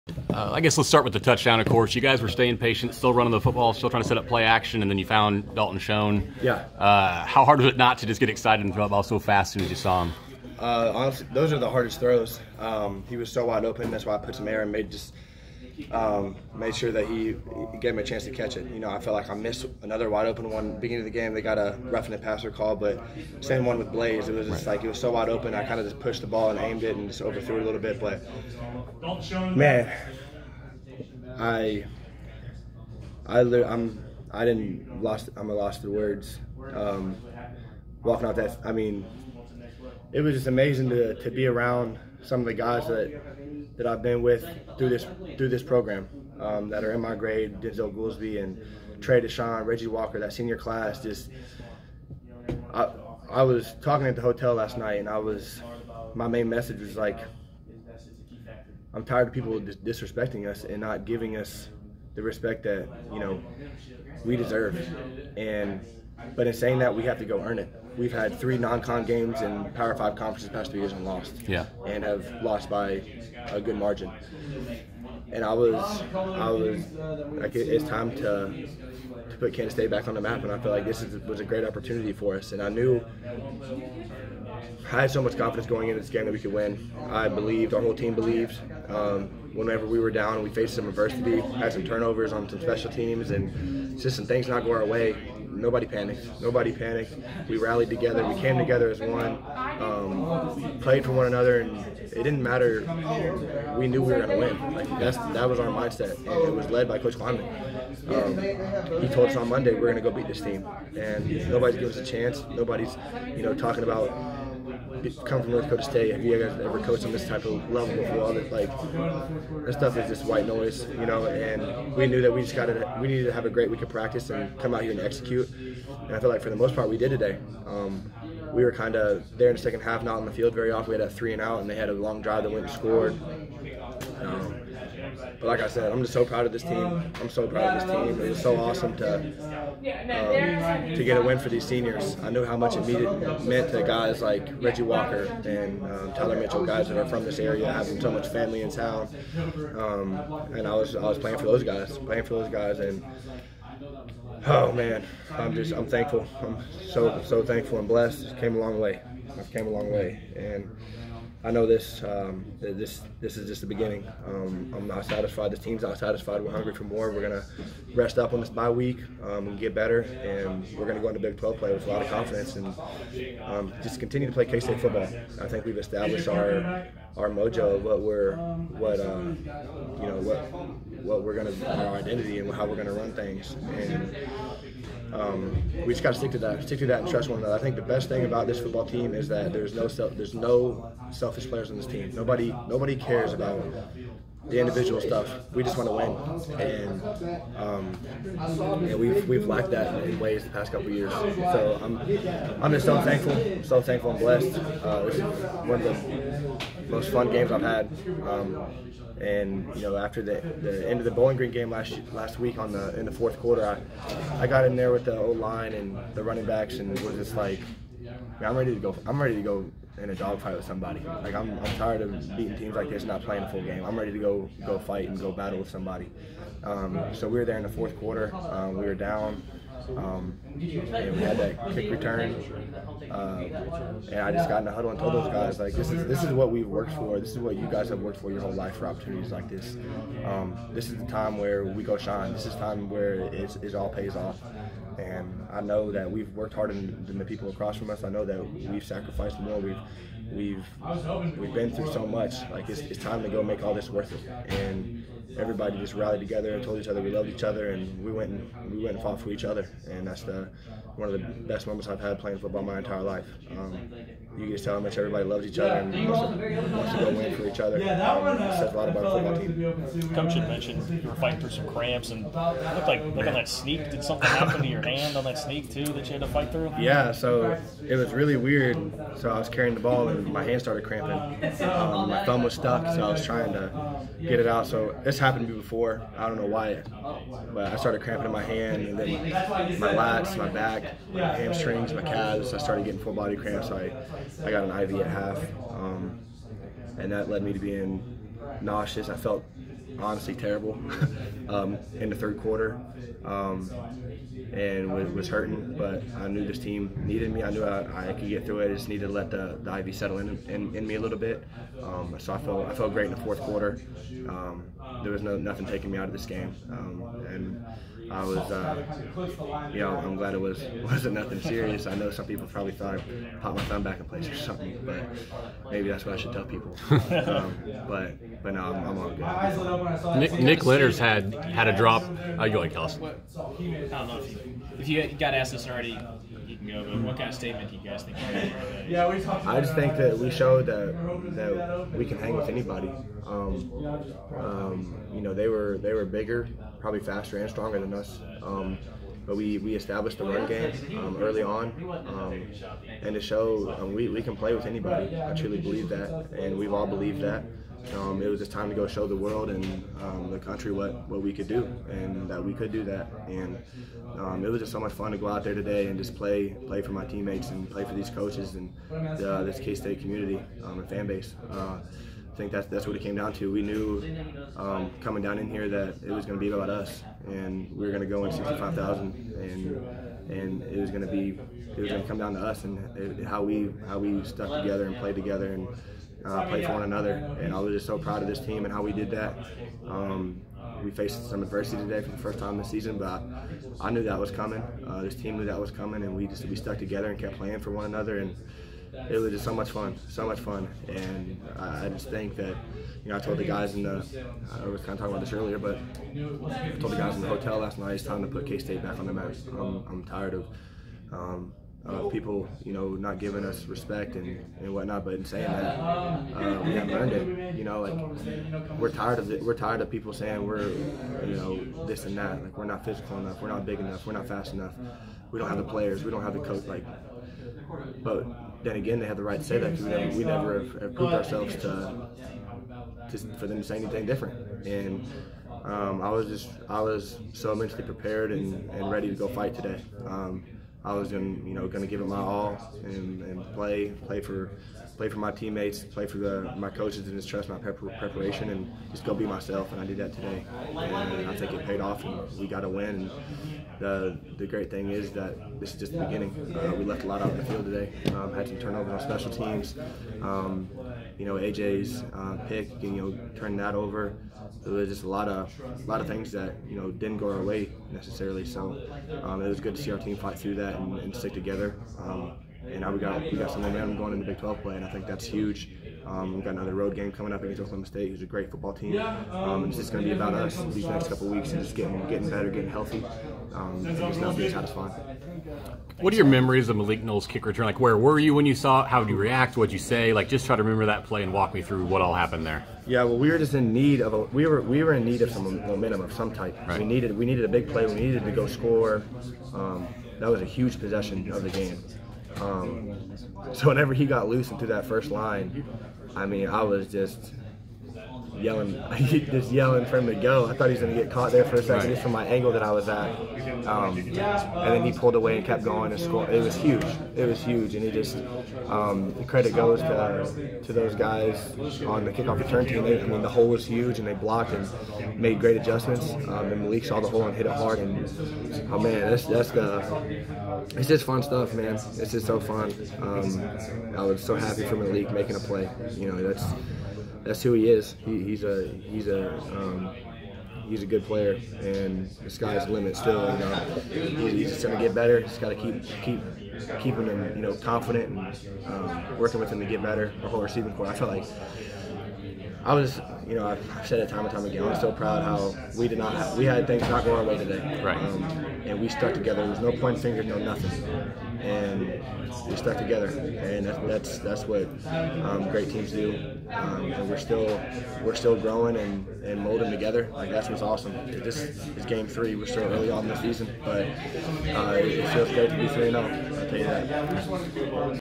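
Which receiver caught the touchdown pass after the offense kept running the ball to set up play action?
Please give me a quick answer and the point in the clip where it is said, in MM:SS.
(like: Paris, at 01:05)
Dalton Schoen, at 00:05.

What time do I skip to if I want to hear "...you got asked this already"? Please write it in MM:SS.
05:35.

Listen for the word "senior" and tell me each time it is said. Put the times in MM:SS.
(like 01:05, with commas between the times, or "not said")
00:50, 02:21.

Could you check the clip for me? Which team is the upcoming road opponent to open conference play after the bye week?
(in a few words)
Oklahoma State.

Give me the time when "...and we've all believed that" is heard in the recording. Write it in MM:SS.
05:56.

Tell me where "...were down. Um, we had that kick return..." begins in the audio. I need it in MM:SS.
03:48.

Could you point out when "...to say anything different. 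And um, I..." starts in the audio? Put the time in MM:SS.
07:13.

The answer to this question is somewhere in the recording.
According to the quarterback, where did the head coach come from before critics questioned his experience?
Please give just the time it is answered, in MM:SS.
01:55.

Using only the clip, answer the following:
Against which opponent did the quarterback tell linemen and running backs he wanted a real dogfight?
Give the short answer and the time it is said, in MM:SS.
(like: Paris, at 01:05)
Bowling Green, at 03:31.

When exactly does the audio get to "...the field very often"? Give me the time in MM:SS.
02:10.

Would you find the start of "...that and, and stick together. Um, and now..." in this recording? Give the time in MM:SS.
07:50.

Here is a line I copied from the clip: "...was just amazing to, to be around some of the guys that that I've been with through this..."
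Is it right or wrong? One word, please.
right.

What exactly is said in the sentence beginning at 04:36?
Yeah, so it was really weird.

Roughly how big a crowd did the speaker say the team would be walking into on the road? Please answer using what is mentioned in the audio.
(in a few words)
65,000.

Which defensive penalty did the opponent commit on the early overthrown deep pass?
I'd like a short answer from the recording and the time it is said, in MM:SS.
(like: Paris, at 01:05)
Roughing the passer, at 00:21.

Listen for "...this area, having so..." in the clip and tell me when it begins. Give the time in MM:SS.
02:27.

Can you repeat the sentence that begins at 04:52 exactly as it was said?
I started getting full body cramps.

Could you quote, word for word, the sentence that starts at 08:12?
Yeah, well, we were just in need of a, we were we were in need of some momentum of some type.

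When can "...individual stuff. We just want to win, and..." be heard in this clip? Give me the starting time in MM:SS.
03:14.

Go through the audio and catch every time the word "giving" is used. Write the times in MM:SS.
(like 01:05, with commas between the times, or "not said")
01:01, 01:51, 06:53.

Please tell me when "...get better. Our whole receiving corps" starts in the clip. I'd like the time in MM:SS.
09:09.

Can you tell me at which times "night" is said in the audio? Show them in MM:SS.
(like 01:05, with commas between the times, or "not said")
00:54, 06:47.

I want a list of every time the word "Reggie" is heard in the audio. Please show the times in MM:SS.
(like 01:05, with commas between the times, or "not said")
00:49, 02:24.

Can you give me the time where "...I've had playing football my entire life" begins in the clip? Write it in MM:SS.
04:21.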